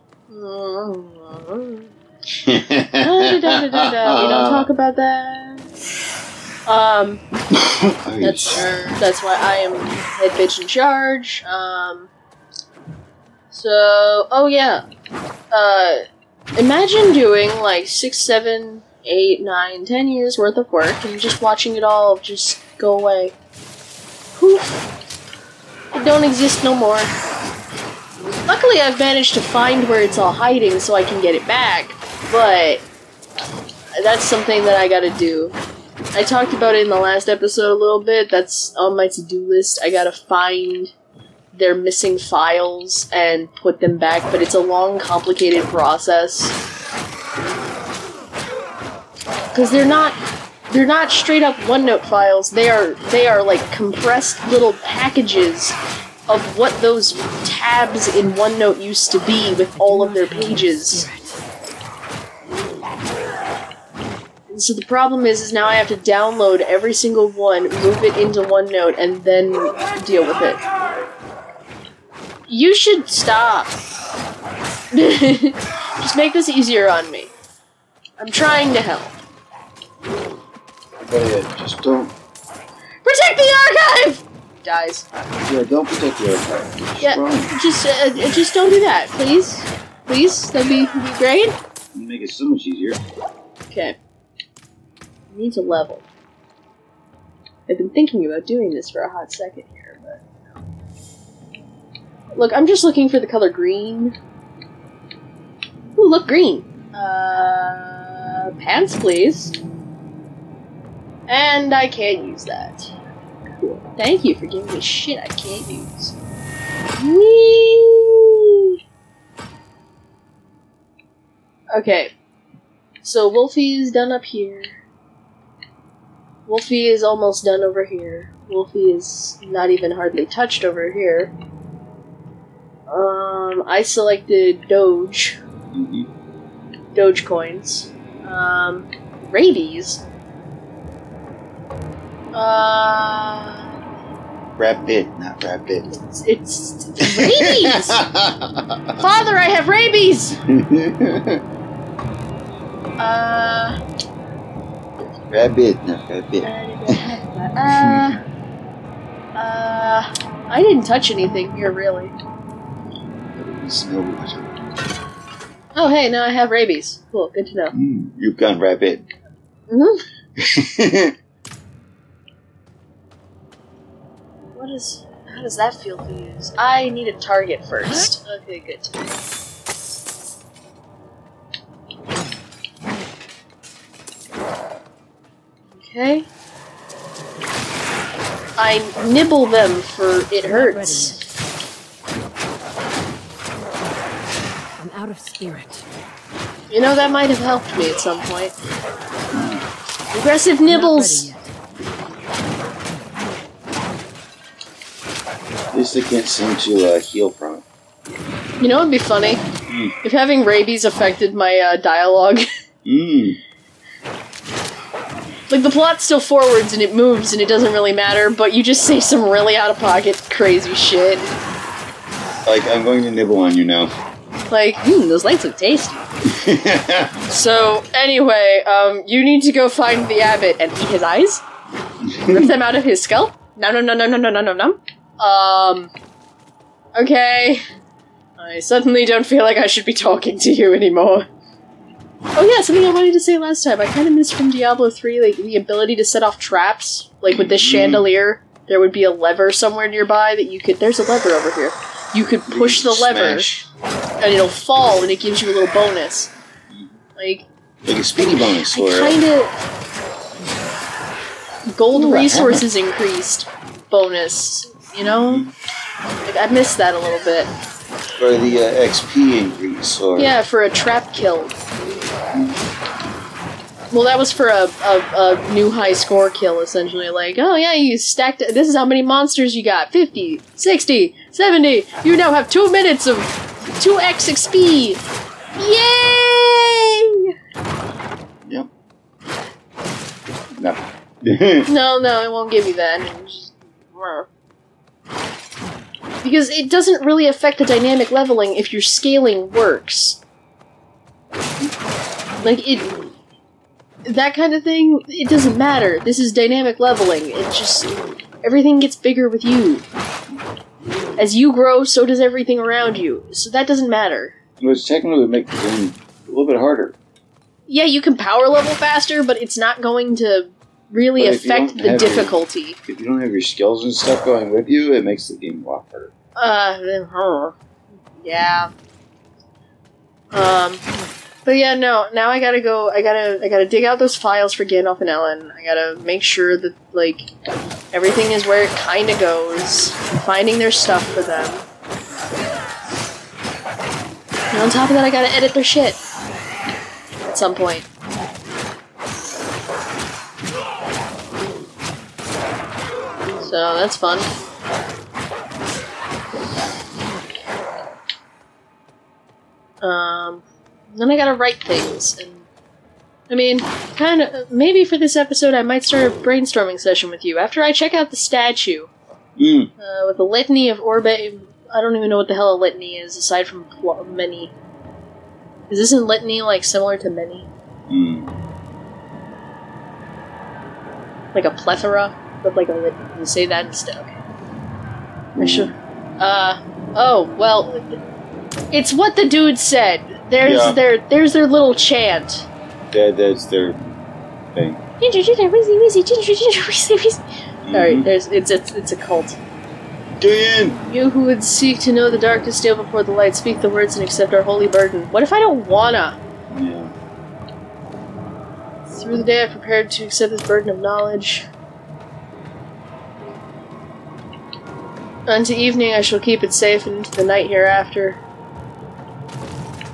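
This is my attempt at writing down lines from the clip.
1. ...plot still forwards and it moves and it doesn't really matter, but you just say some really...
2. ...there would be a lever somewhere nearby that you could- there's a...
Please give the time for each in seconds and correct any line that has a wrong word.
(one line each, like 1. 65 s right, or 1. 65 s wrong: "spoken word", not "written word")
1. 215 s right
2. 248 s right.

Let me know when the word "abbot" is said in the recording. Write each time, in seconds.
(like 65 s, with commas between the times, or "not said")
230 s.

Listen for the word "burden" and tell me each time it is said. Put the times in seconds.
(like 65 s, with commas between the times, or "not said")
404 s, 410 s.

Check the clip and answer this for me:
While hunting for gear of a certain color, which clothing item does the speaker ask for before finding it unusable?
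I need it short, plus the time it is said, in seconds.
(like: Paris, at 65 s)
pants, at 108 s.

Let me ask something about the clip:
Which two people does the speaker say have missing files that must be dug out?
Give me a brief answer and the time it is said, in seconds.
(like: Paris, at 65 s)
Gandalf and Ellen, at 334 s.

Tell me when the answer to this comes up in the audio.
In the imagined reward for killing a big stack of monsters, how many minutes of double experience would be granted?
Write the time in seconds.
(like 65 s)
282 s.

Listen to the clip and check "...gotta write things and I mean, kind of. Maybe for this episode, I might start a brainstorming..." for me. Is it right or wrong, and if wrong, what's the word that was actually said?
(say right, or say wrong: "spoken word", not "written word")
right.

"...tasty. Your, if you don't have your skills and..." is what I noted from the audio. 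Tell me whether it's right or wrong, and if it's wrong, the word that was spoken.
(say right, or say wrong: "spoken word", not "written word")
wrong: "difficulty", not "tasty".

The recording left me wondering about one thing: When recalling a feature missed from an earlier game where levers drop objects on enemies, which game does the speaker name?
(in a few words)
Diablo 3.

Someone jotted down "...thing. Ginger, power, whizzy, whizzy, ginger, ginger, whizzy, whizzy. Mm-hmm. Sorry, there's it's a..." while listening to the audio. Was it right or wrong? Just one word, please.
wrong.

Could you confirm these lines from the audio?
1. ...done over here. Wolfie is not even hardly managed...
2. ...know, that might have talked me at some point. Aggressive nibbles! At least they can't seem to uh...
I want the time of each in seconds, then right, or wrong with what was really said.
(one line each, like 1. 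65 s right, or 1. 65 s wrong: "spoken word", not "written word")
1. 127 s wrong: "touched", not "managed"
2. 196 s wrong: "helped", not "talked".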